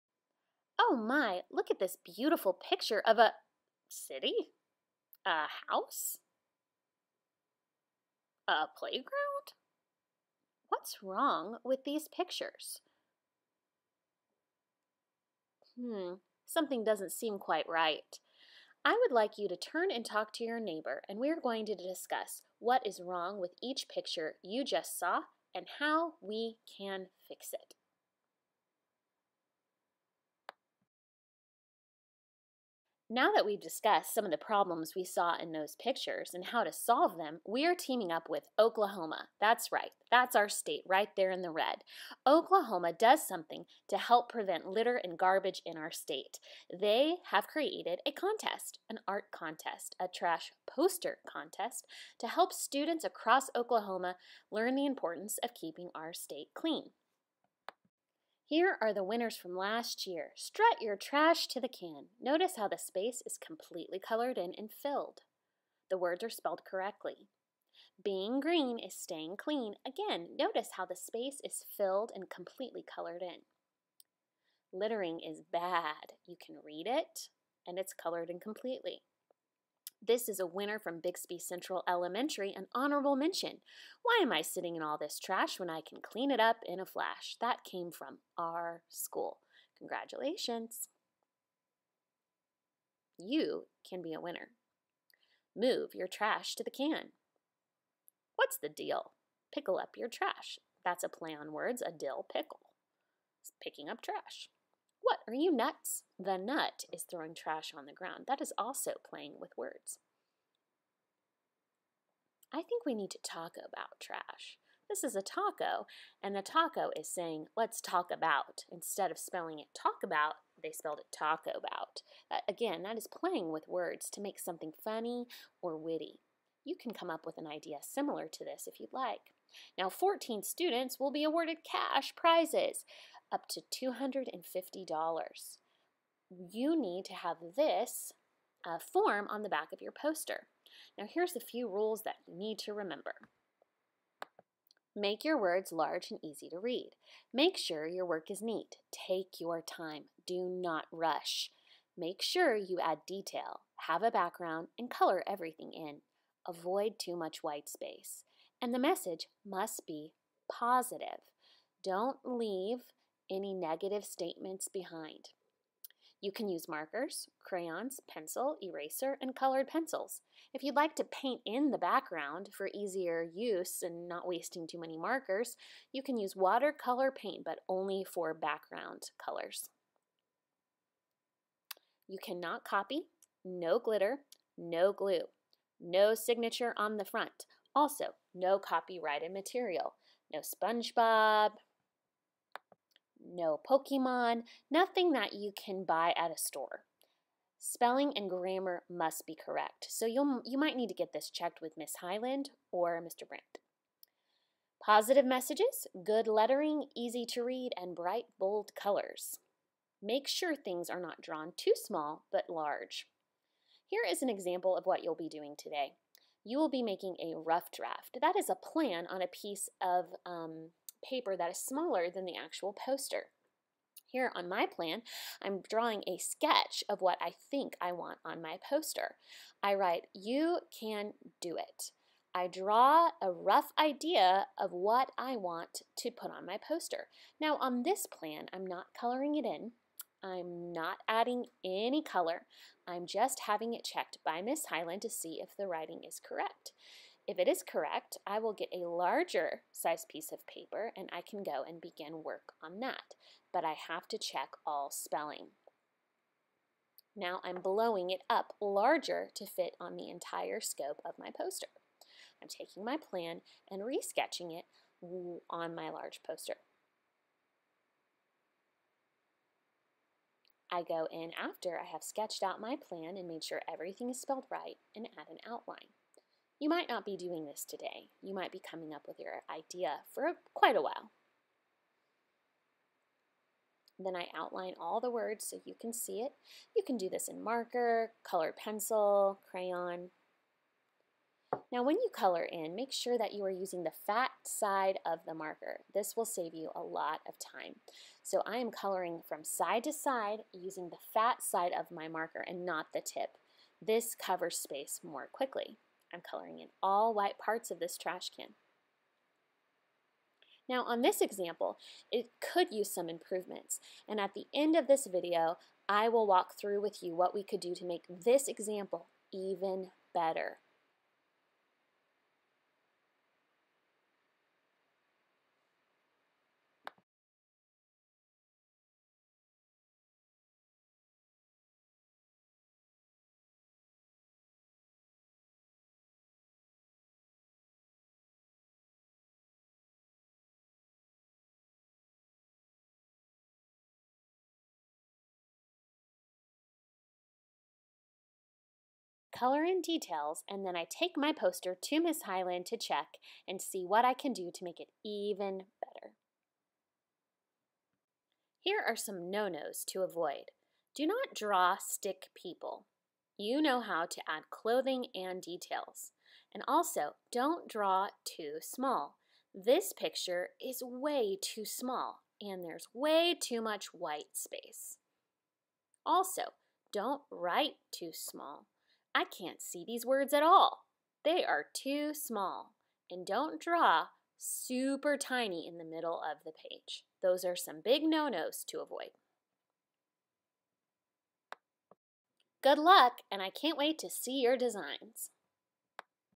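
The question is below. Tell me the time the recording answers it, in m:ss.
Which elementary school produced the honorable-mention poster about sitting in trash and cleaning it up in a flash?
1:20.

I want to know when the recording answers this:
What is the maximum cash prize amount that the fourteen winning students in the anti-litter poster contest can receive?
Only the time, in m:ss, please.
2:13.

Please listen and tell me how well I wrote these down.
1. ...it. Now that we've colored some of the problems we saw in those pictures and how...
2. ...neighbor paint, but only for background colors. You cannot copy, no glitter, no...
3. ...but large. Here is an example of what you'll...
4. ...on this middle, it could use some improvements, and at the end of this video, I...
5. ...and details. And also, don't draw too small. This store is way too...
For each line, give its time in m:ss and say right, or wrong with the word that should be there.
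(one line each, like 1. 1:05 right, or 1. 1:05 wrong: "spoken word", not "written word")
1. 0:27 wrong: "discussed", not "colored"
2. 2:56 wrong: "watercolor", not "neighbor"
3. 3:32 right
4. 5:10 wrong: "example", not "middle"
5. 6:05 wrong: "picture", not "store".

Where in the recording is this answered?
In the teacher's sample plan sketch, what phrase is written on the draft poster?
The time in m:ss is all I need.
3:50.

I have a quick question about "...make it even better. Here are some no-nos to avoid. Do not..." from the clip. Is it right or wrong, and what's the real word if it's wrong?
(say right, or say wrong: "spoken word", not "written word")
right.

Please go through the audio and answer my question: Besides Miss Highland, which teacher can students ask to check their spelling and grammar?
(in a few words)
Mr. Brandt.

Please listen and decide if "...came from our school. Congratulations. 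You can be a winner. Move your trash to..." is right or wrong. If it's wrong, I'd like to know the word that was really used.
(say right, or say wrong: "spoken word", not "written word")
right.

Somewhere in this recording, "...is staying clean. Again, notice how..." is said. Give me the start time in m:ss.
1:08.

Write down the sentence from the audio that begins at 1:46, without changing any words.
The nut is throwing trash on the ground.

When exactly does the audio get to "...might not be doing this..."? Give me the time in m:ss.
4:36.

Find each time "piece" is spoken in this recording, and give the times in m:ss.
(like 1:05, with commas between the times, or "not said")
3:39, 4:10.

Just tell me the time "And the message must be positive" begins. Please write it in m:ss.
2:38.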